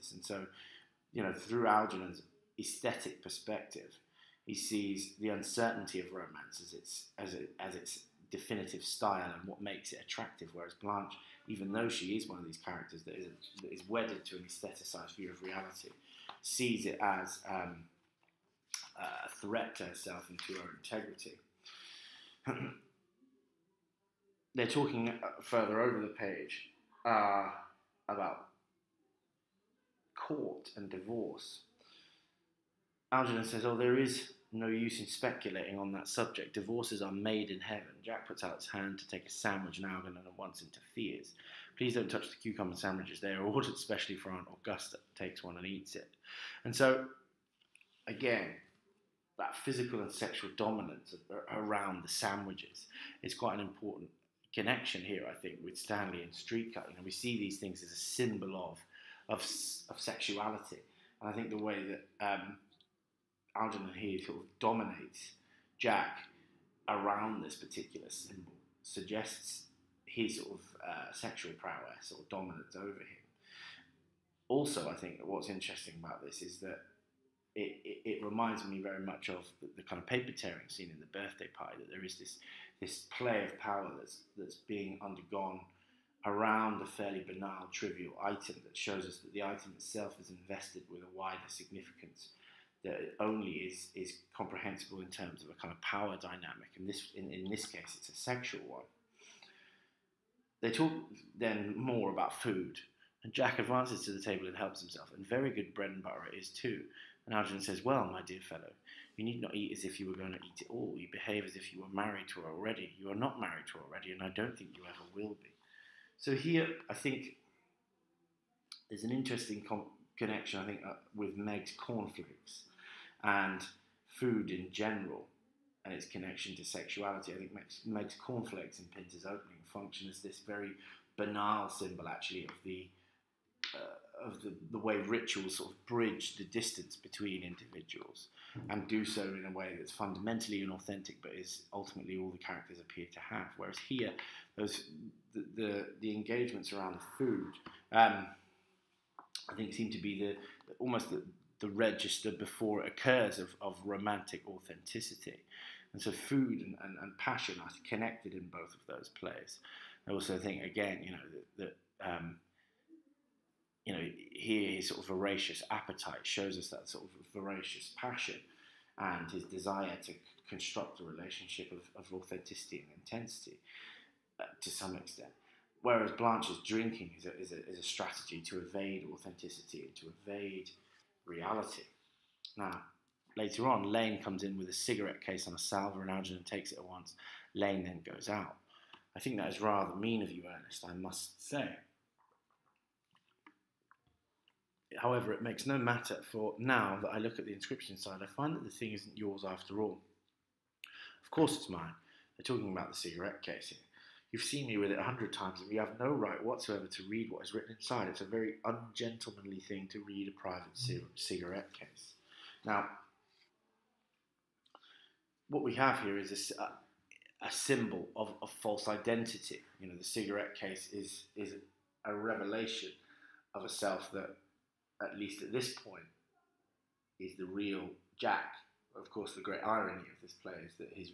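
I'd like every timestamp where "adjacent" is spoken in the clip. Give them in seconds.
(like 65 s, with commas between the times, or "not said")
not said.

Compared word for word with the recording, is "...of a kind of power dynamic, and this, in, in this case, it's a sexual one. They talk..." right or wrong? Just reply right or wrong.
right.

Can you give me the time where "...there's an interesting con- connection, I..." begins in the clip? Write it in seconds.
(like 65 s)
118 s.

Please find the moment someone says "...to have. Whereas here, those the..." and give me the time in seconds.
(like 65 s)
143 s.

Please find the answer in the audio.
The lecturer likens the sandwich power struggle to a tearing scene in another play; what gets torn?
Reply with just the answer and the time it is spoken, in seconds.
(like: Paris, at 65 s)
Paper, at 80 s.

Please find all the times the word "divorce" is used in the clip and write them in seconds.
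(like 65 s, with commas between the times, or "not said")
30 s, 36 s.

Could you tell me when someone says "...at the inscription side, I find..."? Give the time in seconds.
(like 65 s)
197 s.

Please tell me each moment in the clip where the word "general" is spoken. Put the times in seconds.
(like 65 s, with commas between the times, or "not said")
124 s.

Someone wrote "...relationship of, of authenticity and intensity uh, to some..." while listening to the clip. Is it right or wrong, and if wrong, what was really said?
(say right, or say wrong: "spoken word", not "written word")
right.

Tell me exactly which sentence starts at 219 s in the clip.
You know, the cigarette case is is a revelation of a self that at least at this point, is the real Jack.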